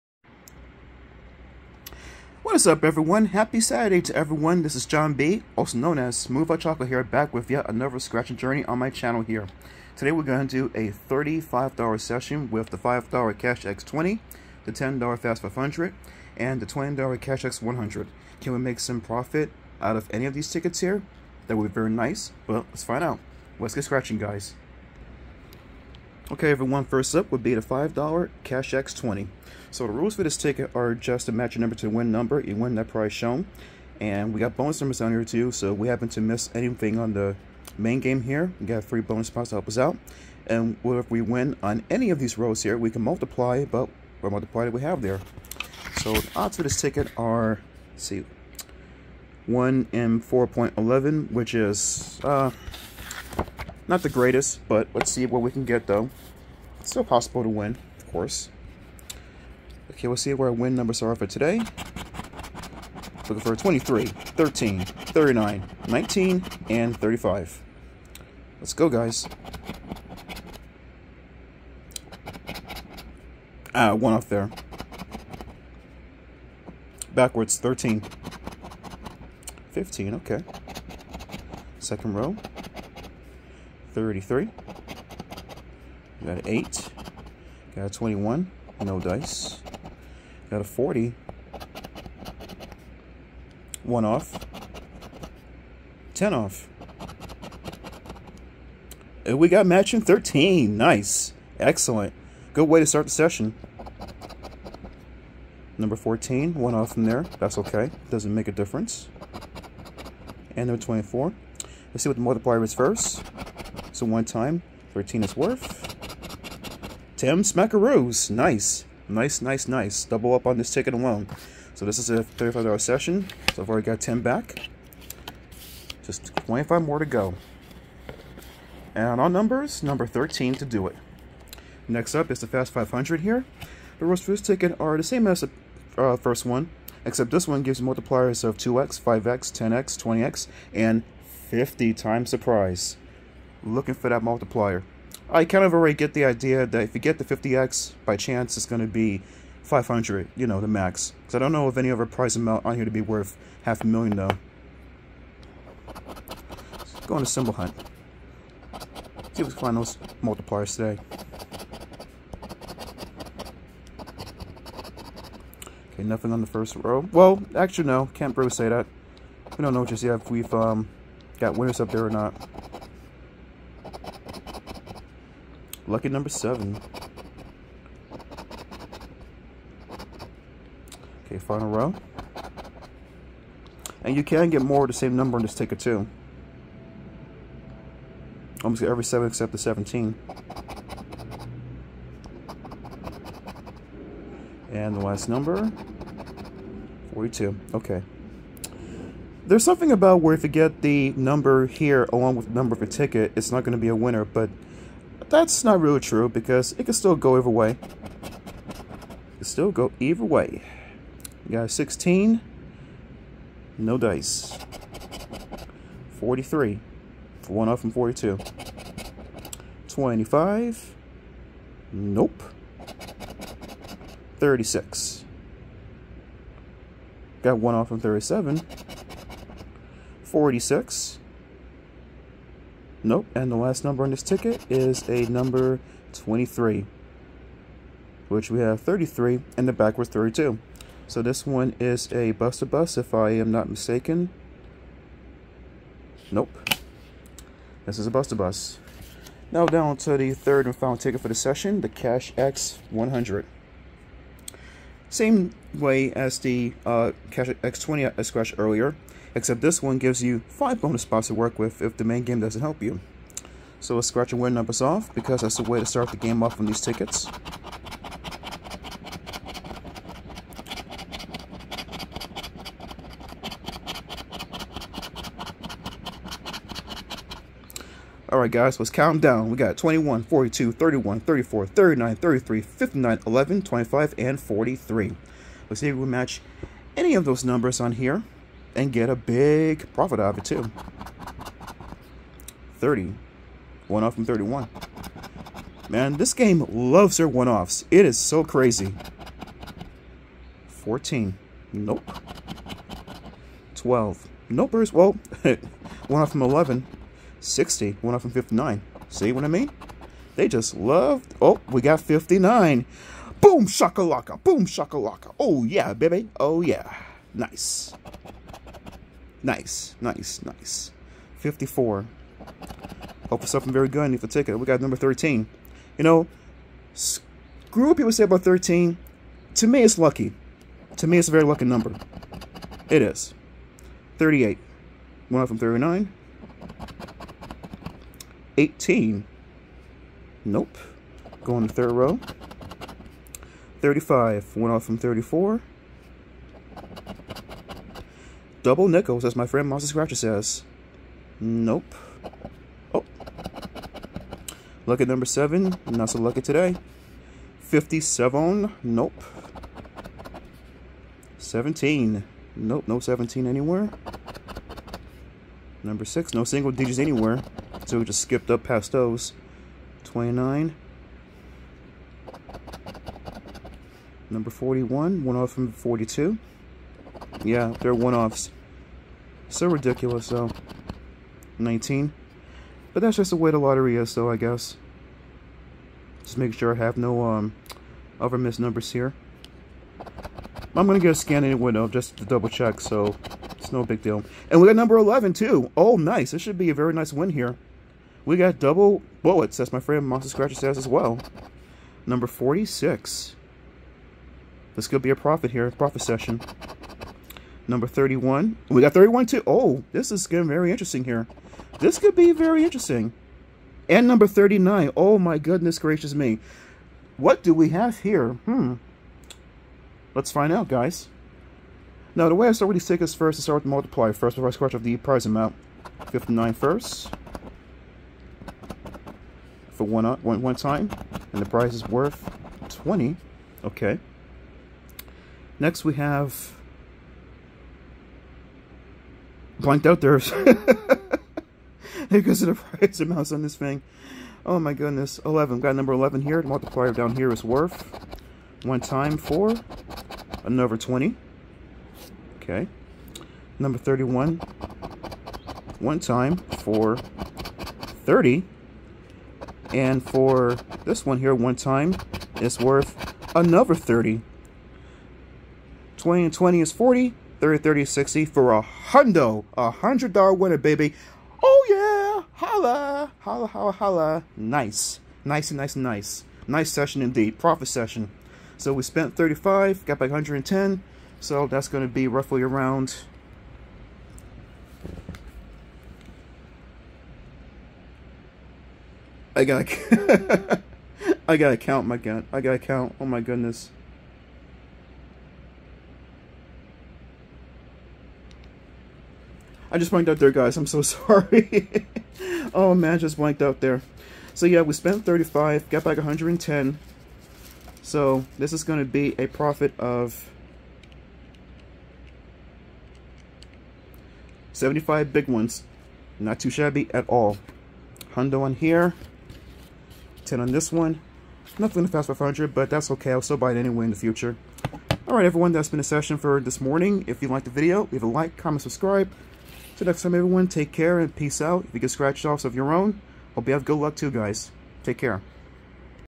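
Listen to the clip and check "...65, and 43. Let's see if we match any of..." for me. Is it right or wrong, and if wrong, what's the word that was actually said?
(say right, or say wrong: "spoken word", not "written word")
wrong: "25", not "65".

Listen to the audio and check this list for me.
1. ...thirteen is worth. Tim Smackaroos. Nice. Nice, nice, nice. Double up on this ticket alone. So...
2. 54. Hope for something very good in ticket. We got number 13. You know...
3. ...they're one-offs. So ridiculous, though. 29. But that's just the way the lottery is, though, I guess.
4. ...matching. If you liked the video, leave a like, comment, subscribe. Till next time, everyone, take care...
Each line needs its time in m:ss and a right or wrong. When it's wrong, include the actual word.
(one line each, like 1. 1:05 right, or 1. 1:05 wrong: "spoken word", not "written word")
1. 1:54 right
2. 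5:21 right
3. 6:17 wrong: "19", not "29"
4. 8:46 wrong: "morning", not "matching".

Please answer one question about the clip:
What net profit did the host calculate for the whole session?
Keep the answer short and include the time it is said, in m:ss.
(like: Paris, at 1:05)
$75, at 8:34.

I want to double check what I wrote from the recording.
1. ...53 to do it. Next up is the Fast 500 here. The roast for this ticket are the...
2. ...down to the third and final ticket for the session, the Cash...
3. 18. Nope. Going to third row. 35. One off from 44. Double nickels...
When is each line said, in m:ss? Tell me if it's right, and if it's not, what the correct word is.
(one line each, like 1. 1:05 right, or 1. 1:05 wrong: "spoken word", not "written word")
1. 2:10 wrong: "13", not "53"
2. 4:09 right
3. 5:38 wrong: "34", not "44".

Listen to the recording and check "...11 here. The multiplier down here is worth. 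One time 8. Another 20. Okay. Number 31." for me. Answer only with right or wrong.
wrong.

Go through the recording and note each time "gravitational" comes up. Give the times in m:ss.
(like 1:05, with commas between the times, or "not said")
not said.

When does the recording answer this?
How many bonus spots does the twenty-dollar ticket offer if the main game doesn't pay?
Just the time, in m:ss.
4:20.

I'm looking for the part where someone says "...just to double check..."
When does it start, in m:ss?
6:31.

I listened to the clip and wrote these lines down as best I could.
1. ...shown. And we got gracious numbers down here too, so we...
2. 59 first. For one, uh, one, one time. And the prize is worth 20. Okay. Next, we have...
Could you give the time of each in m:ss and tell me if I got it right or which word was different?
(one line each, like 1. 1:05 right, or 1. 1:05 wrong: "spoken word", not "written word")
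1. 0:33 wrong: "bonus", not "gracious"
2. 7:06 right.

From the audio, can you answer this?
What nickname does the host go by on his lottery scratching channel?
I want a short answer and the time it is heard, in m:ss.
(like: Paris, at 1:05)
Smooth Hot Chocolate, at 0:06.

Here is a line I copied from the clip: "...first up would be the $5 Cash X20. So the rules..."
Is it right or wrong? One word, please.
right.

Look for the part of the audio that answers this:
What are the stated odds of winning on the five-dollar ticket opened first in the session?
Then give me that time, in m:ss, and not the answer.
0:49.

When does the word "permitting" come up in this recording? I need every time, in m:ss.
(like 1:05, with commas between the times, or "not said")
not said.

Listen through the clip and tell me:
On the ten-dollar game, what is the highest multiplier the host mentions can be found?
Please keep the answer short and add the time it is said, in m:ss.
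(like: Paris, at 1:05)
50x, at 2:27.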